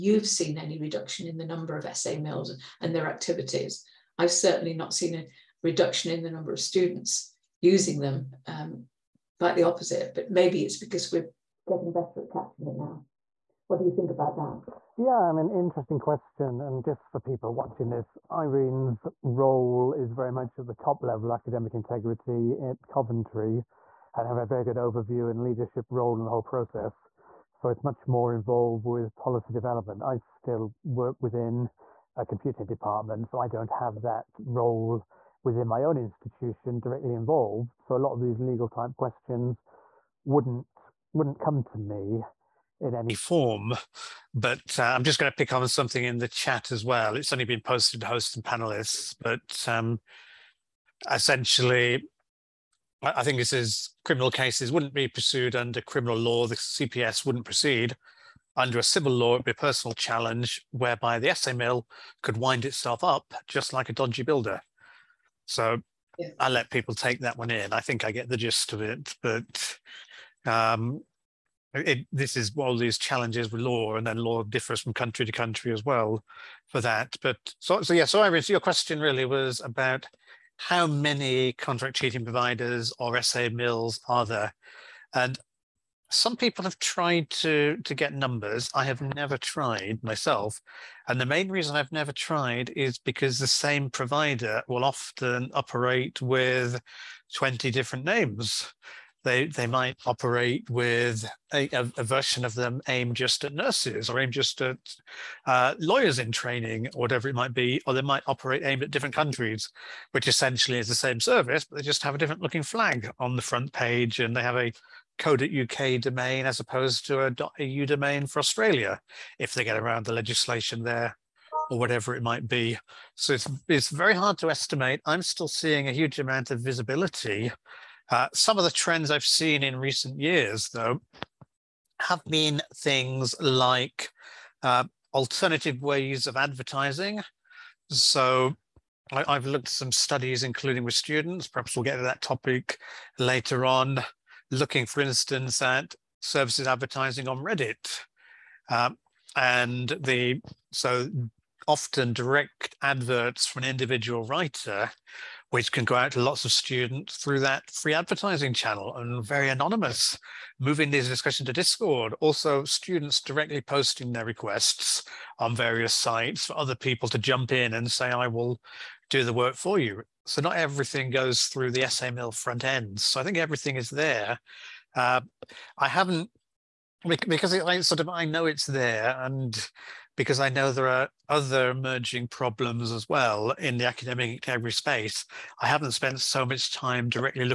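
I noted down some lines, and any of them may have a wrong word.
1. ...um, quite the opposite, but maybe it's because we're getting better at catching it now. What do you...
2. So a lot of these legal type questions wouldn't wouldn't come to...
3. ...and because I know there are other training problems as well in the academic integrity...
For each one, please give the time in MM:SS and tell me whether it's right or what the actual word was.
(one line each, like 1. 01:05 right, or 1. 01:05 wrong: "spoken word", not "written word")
1. 00:08 right
2. 00:37 right
3. 02:59 wrong: "emerging", not "training".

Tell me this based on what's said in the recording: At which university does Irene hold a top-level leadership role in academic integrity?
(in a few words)
Coventry.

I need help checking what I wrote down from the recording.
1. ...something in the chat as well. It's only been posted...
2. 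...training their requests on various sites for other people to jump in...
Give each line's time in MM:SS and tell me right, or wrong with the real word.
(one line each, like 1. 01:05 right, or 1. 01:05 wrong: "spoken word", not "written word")
1. 00:45 right
2. 02:43 wrong: "posting", not "training".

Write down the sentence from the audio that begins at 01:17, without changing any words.
But so, so yeah, so Iris, your question really was about how many contract cheating providers or essay mills are there?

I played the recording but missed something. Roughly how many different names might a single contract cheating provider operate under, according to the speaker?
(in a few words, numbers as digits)
20.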